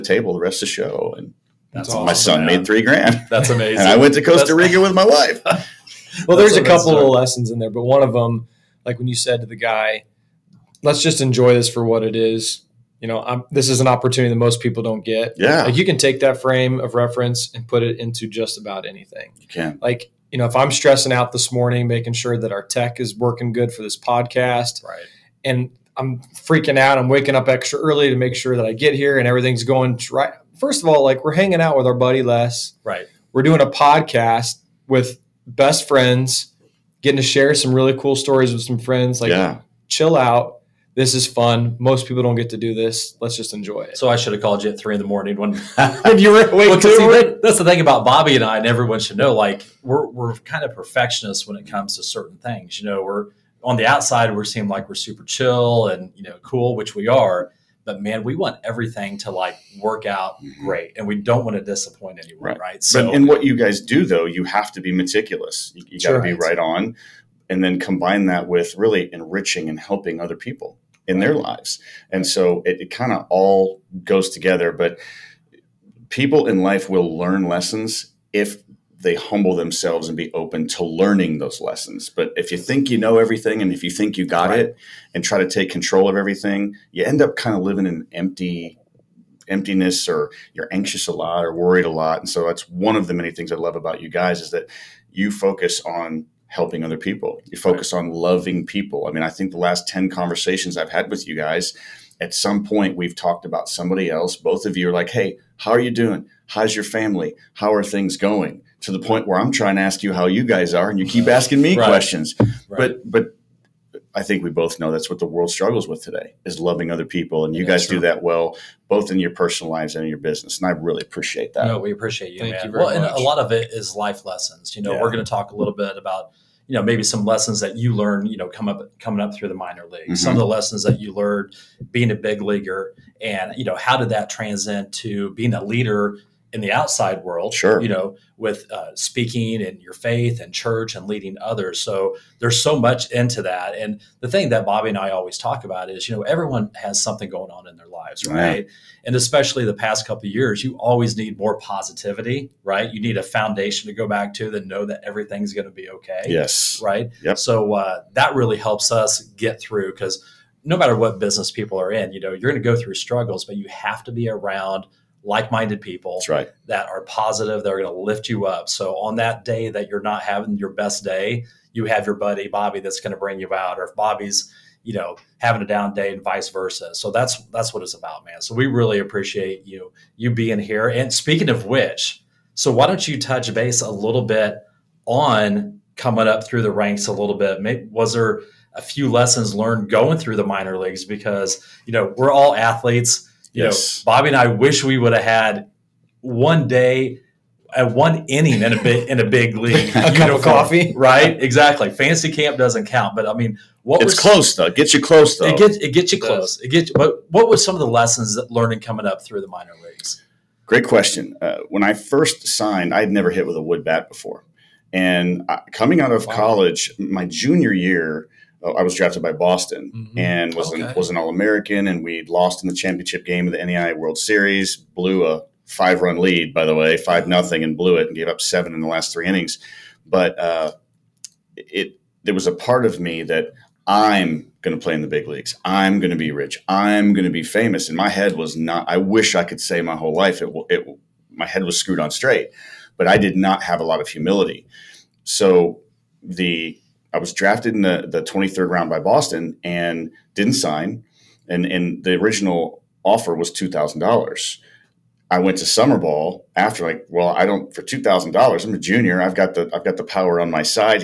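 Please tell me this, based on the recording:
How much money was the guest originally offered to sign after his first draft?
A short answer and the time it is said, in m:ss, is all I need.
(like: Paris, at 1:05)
$2,000, at 4:13.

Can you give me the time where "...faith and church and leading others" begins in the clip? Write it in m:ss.
2:19.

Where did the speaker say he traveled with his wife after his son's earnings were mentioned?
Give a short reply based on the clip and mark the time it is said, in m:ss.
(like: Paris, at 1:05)
Costa Rica, at 0:04.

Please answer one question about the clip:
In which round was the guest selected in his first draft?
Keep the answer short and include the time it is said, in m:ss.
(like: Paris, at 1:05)
23rd, at 4:08.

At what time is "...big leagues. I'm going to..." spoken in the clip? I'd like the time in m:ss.
3:55.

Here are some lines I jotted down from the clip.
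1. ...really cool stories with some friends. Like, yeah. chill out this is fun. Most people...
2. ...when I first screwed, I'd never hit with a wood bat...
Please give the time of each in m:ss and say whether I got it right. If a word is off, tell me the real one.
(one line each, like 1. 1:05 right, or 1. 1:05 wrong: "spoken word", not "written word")
1. 0:37 right
2. 3:31 wrong: "signed", not "screwed".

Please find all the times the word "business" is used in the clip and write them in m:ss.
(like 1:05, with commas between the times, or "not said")
2:00, 2:41.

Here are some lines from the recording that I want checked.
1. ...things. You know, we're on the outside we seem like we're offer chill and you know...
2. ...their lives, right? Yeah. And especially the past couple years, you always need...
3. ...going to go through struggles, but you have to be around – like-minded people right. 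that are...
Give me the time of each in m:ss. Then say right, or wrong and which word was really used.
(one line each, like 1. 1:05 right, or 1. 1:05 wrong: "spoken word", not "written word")
1. 0:52 wrong: "super", not "offer"
2. 2:27 right
3. 2:42 right.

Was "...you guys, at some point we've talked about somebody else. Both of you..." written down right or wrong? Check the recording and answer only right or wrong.
right.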